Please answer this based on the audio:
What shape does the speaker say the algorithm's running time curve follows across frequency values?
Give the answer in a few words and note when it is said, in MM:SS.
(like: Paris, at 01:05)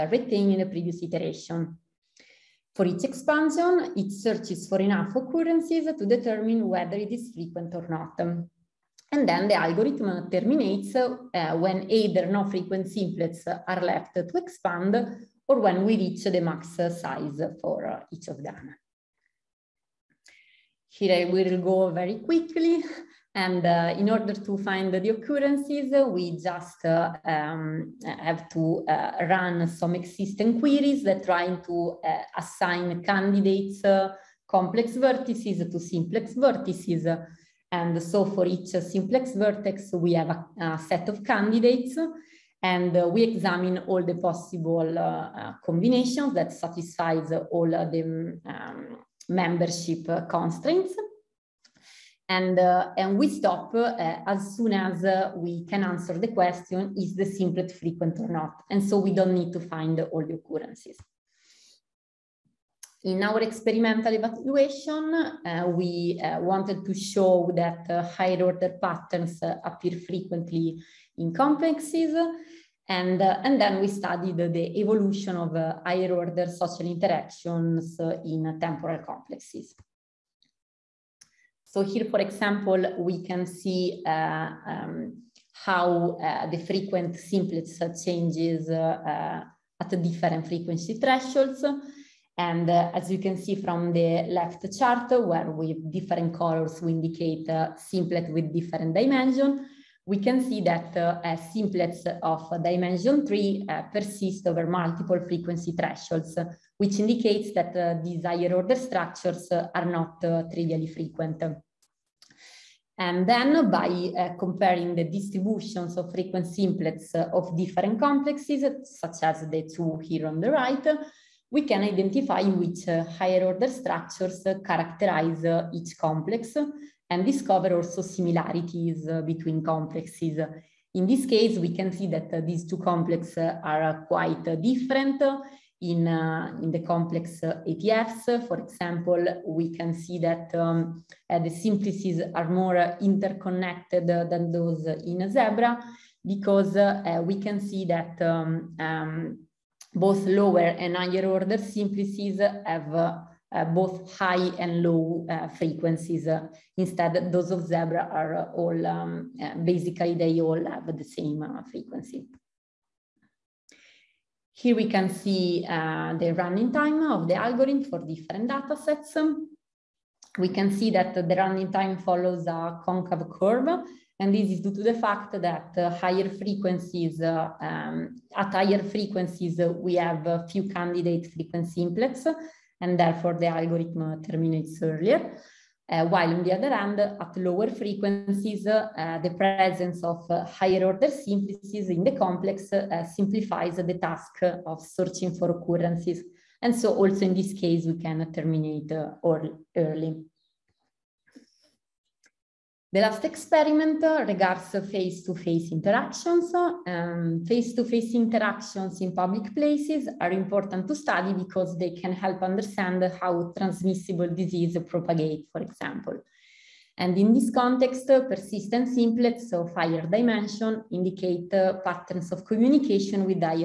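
concave, at 02:52.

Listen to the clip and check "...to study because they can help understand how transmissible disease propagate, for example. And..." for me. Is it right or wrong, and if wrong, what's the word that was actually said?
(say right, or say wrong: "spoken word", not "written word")
right.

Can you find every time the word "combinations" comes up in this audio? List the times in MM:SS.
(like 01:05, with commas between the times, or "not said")
00:45.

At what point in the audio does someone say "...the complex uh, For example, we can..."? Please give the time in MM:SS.
02:16.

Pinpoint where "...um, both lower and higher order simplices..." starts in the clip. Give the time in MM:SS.
02:28.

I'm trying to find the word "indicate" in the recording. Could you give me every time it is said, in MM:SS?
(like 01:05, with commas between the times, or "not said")
01:36, 01:46, 03:40.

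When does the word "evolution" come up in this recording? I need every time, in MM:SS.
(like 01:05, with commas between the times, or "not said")
01:14.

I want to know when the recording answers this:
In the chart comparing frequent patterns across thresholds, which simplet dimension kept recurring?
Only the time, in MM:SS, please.
01:42.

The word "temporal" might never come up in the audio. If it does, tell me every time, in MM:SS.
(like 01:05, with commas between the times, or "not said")
01:18.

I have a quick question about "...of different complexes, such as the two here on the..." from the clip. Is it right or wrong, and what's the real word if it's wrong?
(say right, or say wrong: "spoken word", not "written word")
right.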